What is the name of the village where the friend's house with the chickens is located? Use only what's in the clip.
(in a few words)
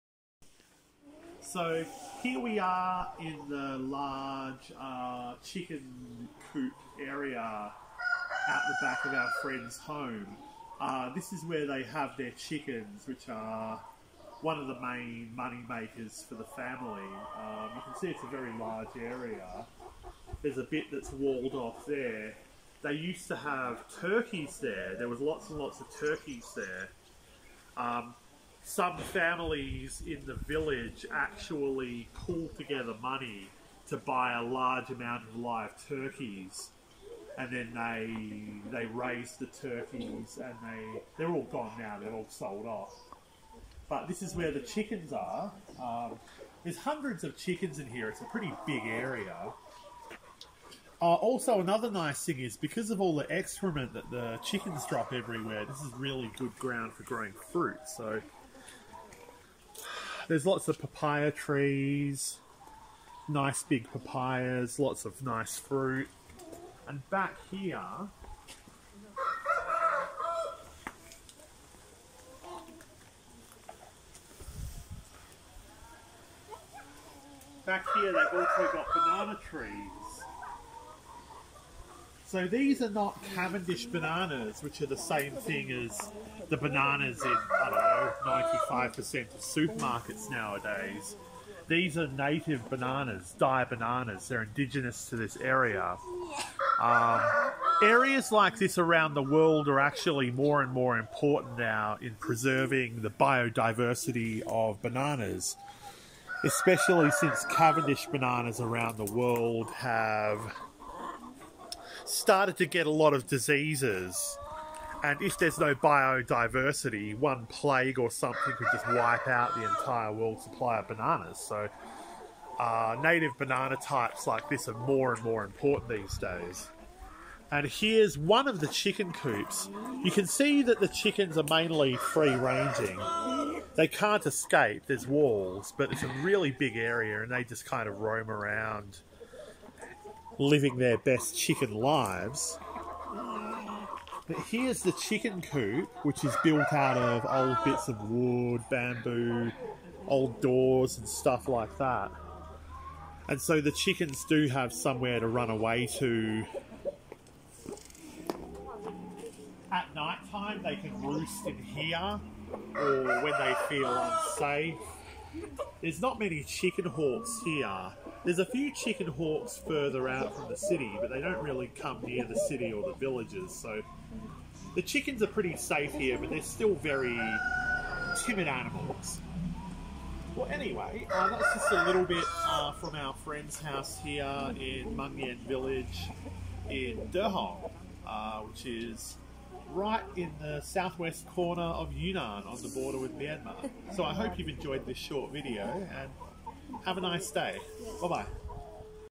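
Mangyan Village.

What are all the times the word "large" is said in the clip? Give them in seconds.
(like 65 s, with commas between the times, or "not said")
3 s, 18 s, 34 s.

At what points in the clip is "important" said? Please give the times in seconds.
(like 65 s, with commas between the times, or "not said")
100 s, 125 s.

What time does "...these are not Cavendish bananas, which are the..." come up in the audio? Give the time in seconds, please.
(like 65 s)
82 s.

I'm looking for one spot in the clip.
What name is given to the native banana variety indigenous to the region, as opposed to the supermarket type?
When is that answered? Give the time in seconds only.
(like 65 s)
93 s.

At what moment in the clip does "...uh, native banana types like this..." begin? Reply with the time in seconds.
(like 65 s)
122 s.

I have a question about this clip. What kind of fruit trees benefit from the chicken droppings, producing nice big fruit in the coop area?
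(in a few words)
Papaya.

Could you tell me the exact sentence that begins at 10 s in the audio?
Uh, this is where they have their chickens, which are one of the main money makers for the family.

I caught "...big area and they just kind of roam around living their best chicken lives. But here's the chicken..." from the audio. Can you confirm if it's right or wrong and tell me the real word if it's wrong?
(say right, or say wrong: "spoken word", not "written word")
right.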